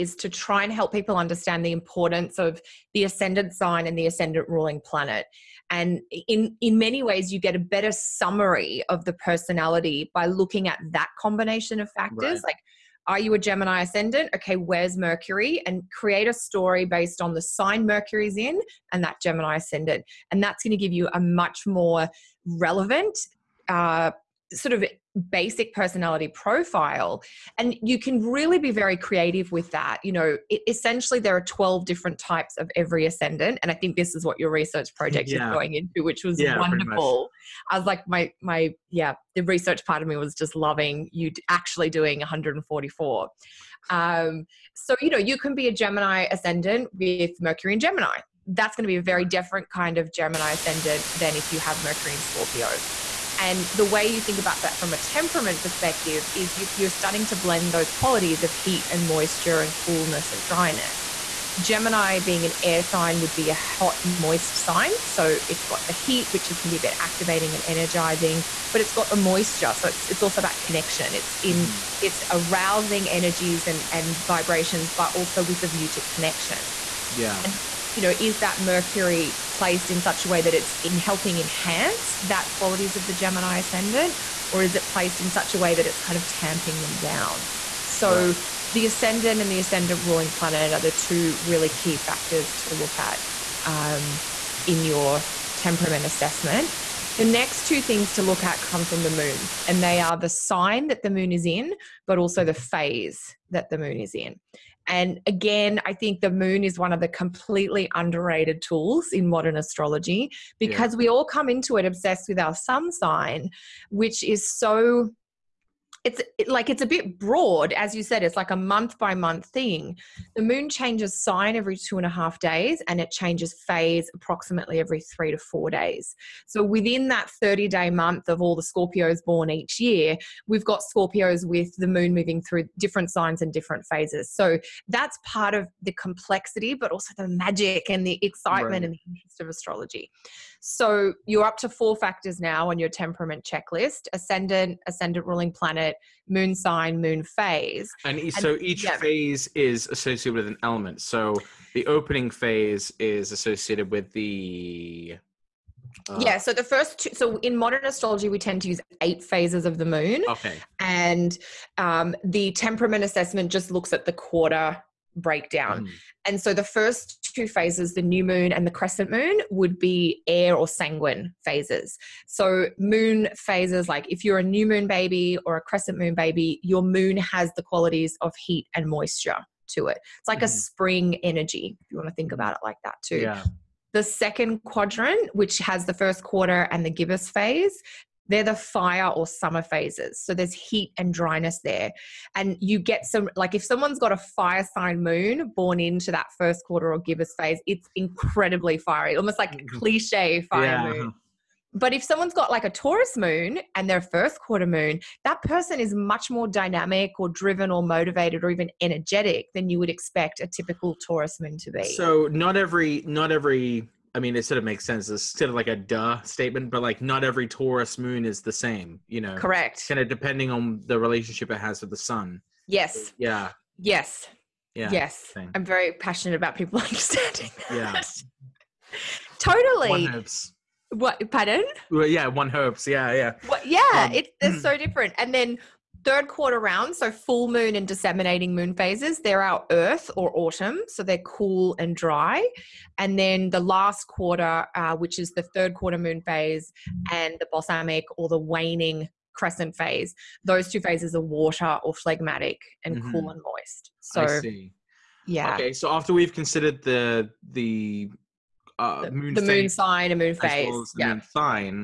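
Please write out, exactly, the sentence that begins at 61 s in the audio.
Gemini being an air sign would be a hot, moist sign.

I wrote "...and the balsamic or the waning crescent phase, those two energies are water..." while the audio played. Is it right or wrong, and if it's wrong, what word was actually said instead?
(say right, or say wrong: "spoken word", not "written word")
wrong: "phases", not "energies".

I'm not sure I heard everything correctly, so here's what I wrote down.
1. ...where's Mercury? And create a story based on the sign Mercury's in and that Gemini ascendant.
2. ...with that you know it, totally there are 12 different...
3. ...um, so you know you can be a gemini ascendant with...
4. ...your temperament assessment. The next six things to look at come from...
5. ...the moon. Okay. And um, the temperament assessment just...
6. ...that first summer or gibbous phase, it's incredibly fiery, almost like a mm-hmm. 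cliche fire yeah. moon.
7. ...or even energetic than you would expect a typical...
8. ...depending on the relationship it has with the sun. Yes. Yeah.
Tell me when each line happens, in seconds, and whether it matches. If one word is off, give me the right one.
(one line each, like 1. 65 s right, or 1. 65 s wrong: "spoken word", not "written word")
1. 14 s right
2. 29 s wrong: "essentially", not "totally"
3. 43 s right
4. 94 s wrong: "two", not "six"
5. 159 s right
6. 196 s wrong: "quarter", not "summer"
7. 208 s right
8. 220 s right.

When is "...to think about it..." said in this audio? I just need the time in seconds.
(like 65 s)
182 s.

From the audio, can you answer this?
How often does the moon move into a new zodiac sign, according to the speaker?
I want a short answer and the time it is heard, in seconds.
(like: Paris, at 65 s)
every two and a half days, at 121 s.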